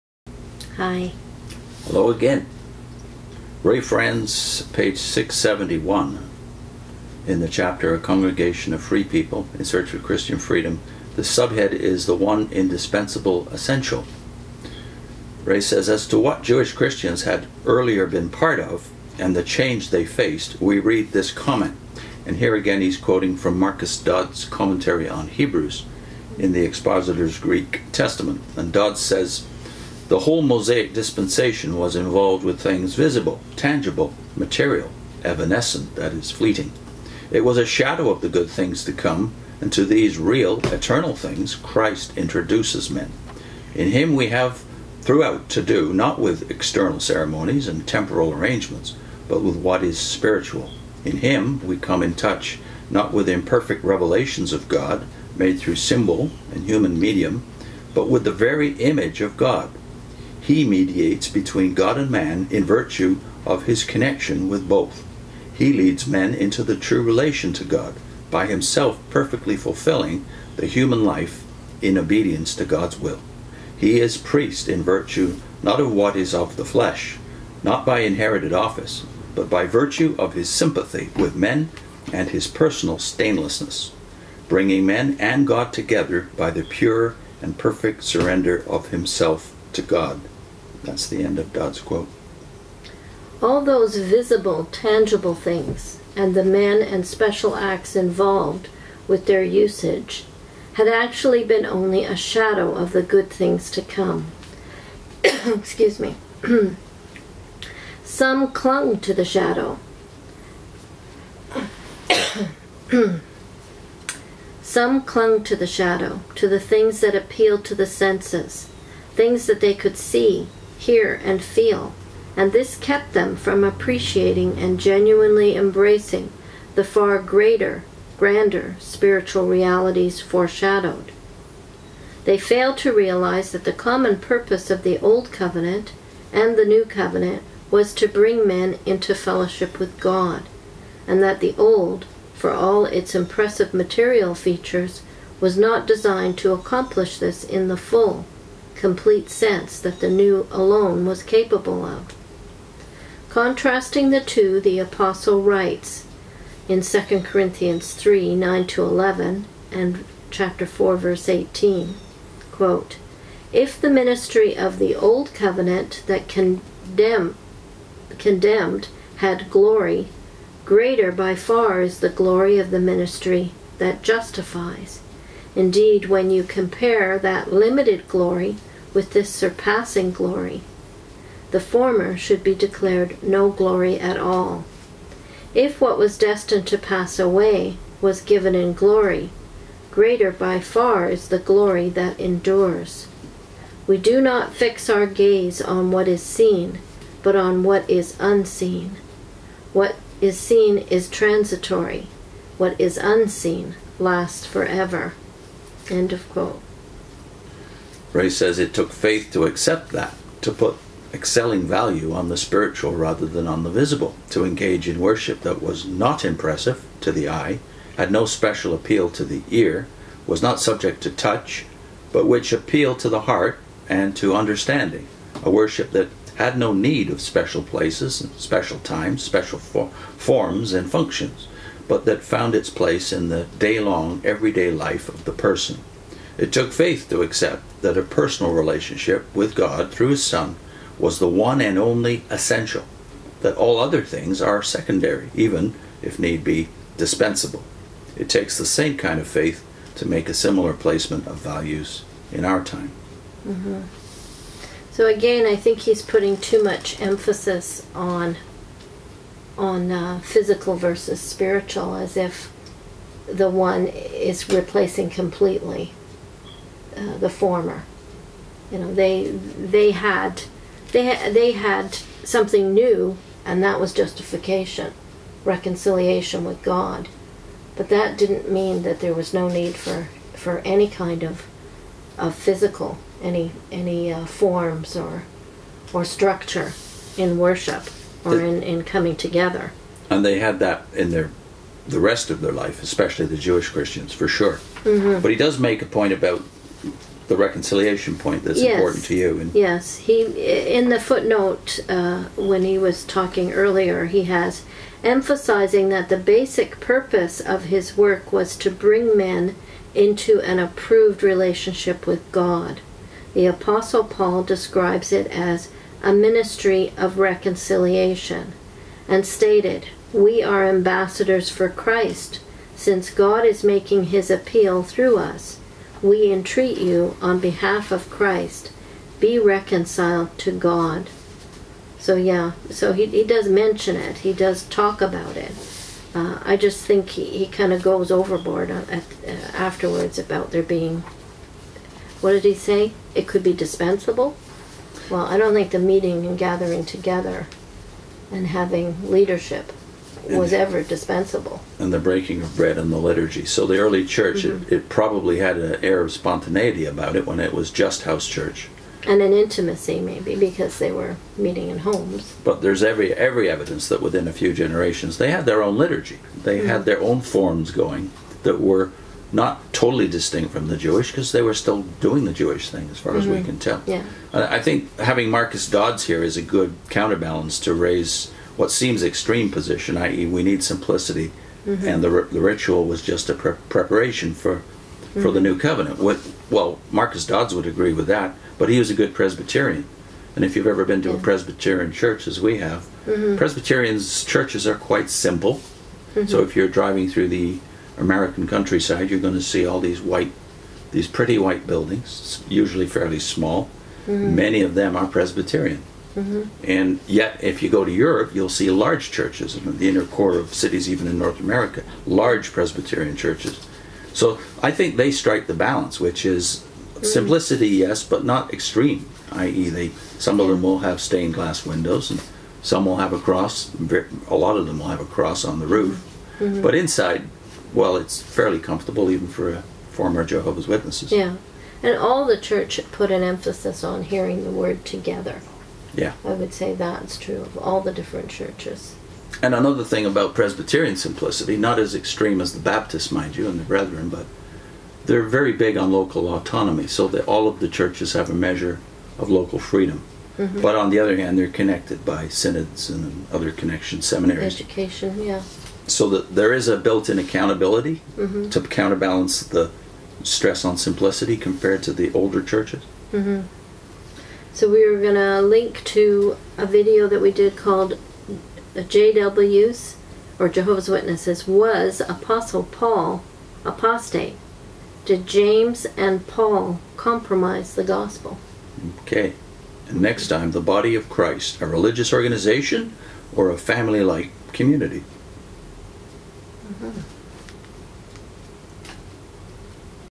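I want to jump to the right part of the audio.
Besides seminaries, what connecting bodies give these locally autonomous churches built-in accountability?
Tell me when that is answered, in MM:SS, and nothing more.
07:32.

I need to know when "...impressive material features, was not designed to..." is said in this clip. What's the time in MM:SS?
02:23.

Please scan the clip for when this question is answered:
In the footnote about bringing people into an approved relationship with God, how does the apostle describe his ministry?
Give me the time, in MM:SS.
05:16.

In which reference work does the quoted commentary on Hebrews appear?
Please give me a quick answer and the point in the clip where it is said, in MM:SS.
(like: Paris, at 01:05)
The Expositor's Greek Testament, at 00:26.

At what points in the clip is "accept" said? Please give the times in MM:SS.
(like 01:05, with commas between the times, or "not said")
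03:29, 03:57.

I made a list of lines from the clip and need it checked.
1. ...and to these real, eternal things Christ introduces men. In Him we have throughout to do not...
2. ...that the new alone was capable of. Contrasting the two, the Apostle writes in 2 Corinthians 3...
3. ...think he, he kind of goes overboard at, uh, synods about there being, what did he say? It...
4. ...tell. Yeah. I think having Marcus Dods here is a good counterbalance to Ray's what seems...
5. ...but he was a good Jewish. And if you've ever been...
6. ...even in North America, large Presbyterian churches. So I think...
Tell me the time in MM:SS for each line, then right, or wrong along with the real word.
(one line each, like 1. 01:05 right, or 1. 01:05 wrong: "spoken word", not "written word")
1. 00:39 right
2. 02:29 right
3. 05:36 wrong: "afterwards", not "synods"
4. 06:13 right
5. 06:28 wrong: "Presbyterian", not "Jewish"
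6. 06:50 right.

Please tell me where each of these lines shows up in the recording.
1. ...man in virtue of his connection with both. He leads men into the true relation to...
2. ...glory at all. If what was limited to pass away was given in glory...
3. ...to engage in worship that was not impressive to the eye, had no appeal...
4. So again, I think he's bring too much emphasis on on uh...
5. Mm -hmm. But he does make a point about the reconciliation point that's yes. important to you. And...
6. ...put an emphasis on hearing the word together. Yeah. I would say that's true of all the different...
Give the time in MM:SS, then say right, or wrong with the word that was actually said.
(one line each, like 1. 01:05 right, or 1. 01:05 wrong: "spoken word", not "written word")
1. 01:02 right
2. 03:03 wrong: "destined", not "limited"
3. 03:34 wrong: "special", not "appeal"
4. 04:14 wrong: "putting", not "bring"
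5. 04:54 right
6. 07:12 right.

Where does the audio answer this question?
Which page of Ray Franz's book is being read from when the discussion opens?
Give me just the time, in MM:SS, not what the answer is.
00:04.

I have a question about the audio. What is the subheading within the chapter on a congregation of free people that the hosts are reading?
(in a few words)
The One Indispensable Essential.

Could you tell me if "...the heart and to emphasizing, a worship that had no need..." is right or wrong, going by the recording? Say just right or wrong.
wrong.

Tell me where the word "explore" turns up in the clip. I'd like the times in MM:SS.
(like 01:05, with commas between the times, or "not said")
not said.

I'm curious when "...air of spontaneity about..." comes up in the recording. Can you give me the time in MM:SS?
05:55.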